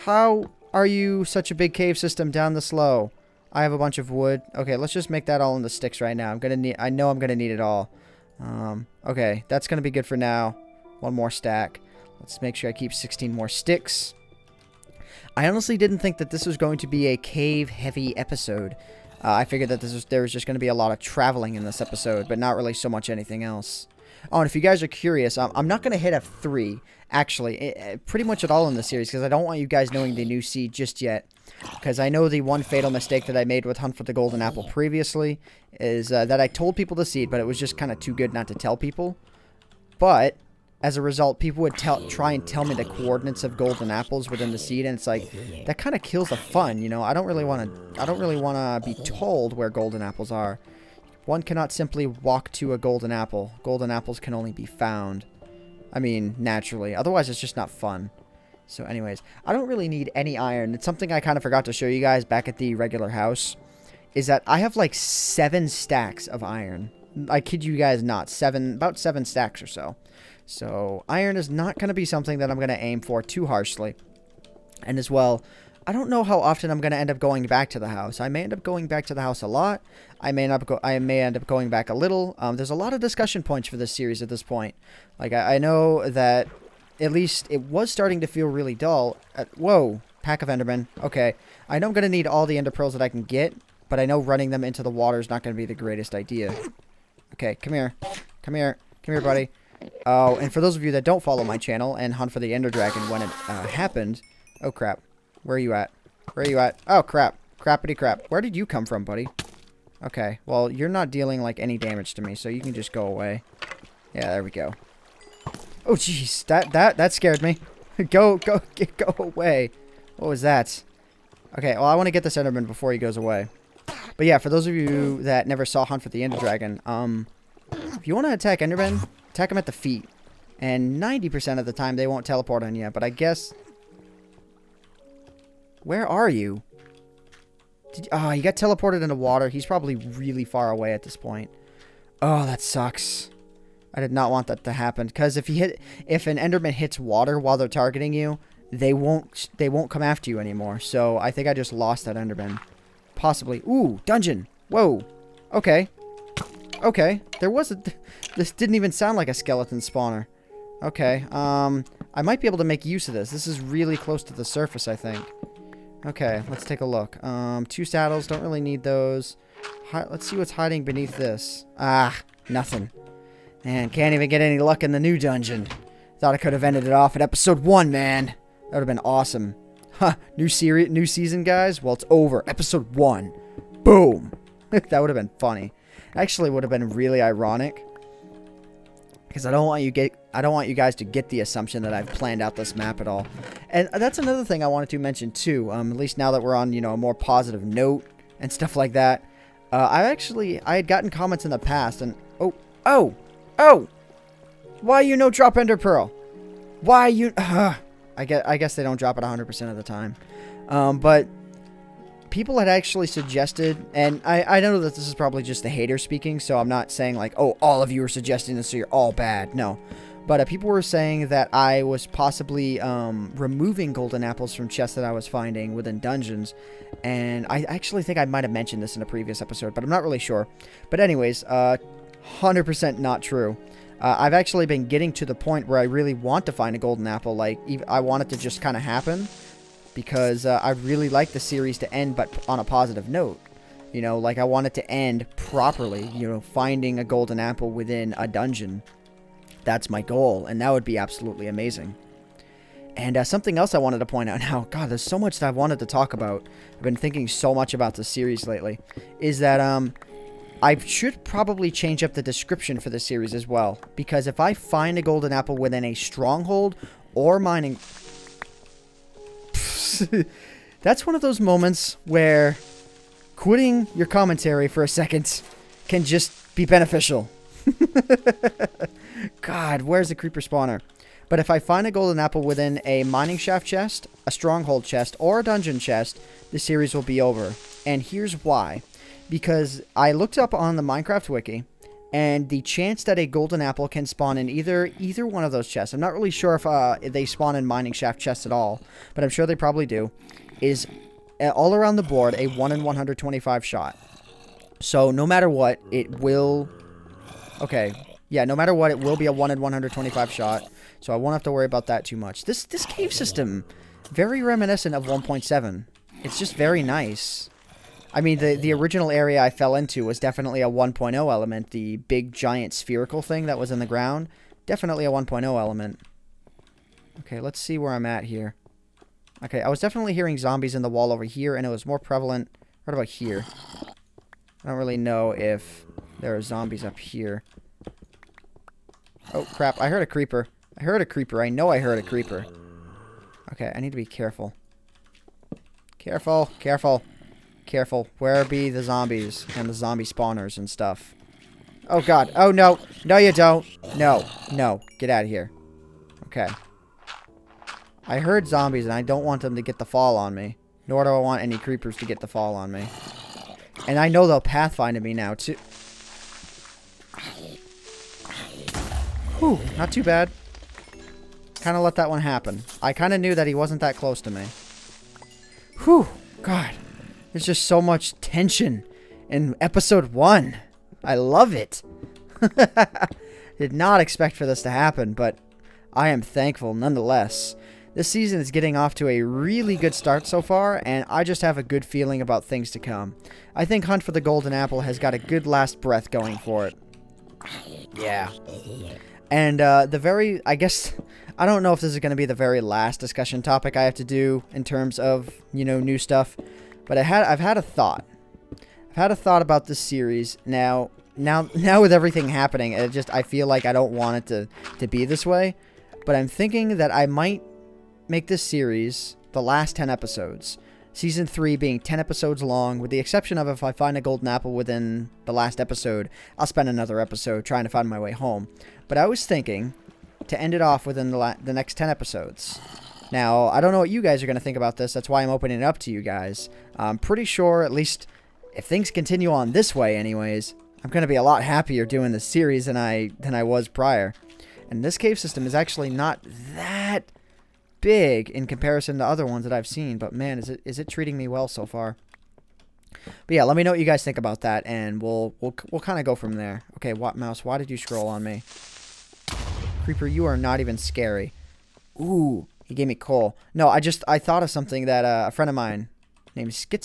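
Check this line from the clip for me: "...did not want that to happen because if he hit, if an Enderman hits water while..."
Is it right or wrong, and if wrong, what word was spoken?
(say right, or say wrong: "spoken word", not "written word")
right.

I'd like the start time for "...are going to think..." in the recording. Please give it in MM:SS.
07:14.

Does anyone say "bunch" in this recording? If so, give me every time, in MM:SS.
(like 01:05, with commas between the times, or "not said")
00:03.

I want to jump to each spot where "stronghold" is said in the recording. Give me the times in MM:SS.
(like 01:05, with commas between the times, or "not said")
04:25, 04:44.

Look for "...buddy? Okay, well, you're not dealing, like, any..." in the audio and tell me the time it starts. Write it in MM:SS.
01:49.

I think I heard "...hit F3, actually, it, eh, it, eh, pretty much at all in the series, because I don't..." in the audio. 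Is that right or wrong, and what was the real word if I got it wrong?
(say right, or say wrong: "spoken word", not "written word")
right.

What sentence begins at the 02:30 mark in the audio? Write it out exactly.
So I think I just lost that Enderman.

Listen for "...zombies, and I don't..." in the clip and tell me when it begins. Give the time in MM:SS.
05:58.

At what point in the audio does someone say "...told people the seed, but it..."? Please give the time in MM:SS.
00:36.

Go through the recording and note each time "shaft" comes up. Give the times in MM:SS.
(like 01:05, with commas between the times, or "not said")
04:43, 04:57.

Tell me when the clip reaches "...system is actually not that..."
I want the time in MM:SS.
07:25.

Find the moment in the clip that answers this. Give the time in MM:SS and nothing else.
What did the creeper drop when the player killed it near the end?
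07:42.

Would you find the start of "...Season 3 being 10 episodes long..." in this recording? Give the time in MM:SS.
07:00.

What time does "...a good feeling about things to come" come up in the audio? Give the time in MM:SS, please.
06:31.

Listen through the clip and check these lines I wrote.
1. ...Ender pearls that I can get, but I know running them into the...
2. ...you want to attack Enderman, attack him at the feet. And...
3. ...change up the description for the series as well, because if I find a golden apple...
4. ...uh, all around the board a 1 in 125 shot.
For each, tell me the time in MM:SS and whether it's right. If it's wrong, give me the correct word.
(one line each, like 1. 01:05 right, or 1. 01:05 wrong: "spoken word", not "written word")
1. 01:32 right
2. 02:08 right
3. 04:21 right
4. 05:01 right.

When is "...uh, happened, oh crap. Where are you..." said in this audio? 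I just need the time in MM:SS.
01:43.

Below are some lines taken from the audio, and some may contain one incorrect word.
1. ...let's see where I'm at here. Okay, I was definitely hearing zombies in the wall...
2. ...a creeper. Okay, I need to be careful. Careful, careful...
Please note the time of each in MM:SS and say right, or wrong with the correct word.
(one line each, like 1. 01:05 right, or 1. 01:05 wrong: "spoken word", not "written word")
1. 05:27 right
2. 05:41 right.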